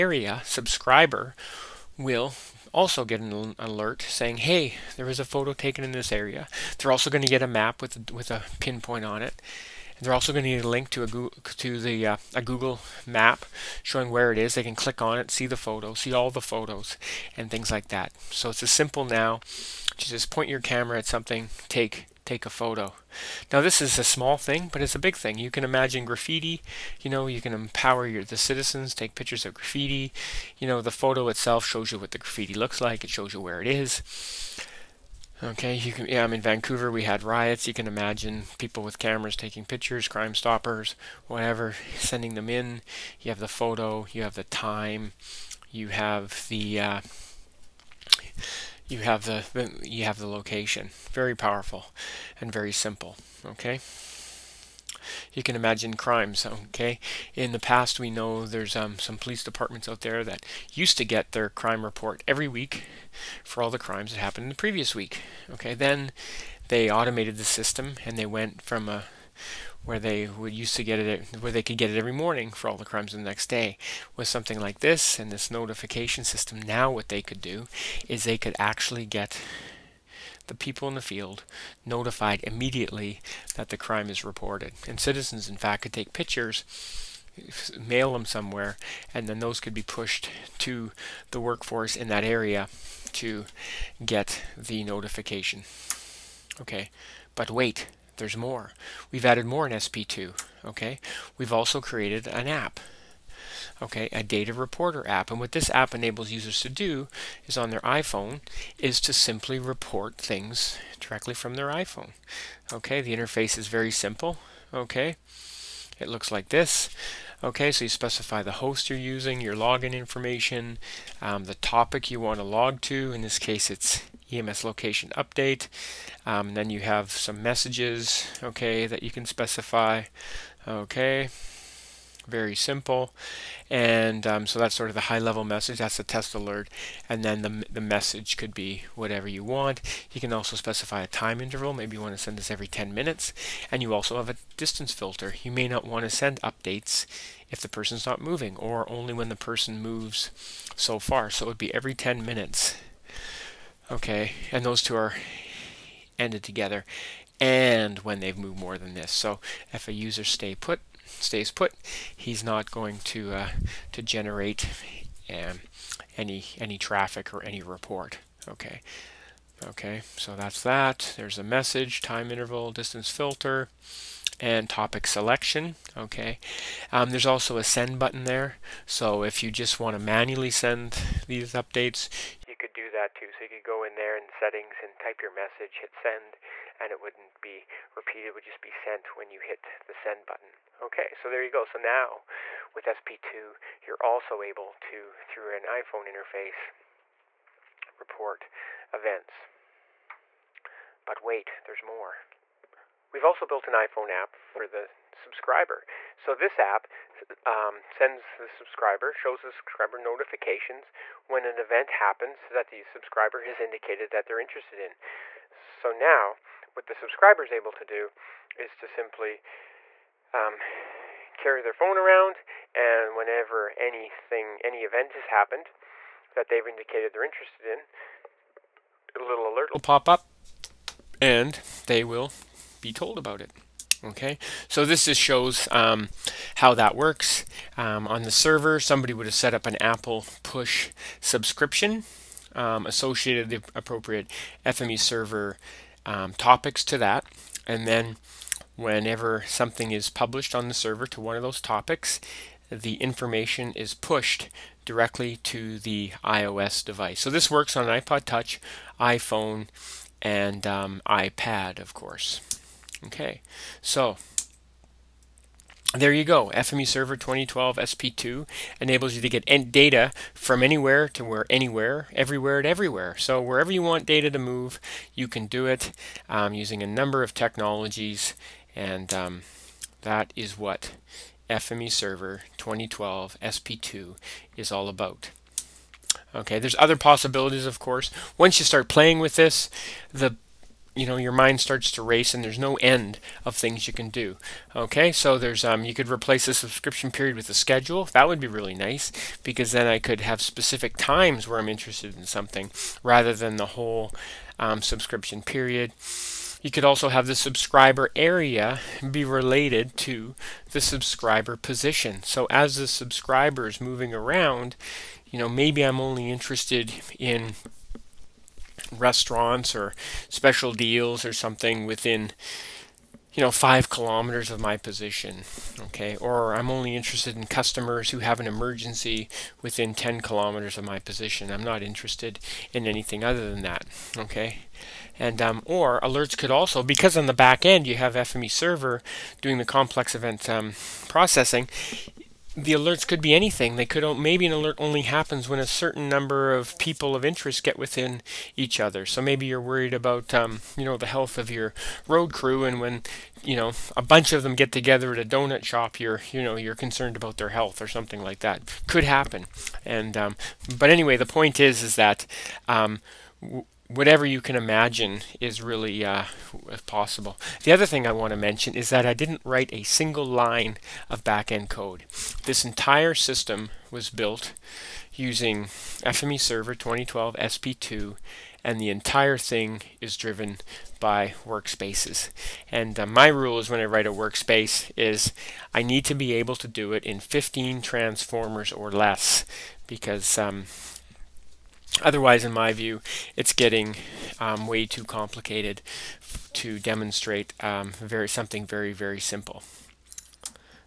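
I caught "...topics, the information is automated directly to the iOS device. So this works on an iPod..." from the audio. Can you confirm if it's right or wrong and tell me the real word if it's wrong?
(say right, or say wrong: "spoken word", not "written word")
wrong: "pushed", not "automated".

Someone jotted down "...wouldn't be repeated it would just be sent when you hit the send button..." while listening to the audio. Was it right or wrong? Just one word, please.
right.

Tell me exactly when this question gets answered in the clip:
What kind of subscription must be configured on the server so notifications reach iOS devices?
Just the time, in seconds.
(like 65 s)
239 s.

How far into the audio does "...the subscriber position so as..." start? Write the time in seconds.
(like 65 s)
310 s.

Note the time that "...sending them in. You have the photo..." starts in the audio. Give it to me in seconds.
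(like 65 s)
41 s.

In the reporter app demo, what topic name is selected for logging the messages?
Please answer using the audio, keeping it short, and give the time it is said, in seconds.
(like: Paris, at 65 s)
EMS location update, at 124 s.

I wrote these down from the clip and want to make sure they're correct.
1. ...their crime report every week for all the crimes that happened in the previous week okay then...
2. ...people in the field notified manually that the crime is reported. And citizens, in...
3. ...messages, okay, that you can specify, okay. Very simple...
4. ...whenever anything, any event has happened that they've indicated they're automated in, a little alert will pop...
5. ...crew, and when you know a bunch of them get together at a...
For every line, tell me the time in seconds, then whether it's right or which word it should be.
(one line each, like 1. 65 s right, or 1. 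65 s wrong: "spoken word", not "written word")
1. 61 s right
2. 80 s wrong: "immediately", not "manually"
3. 127 s right
4. 223 s wrong: "interested", not "automated"
5. 352 s right.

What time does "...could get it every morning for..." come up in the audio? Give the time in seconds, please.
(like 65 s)
71 s.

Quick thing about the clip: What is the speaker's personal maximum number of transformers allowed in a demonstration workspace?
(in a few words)
15.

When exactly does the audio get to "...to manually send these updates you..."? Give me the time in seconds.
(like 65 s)
179 s.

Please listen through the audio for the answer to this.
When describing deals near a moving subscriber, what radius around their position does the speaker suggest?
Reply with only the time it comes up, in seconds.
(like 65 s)
323 s.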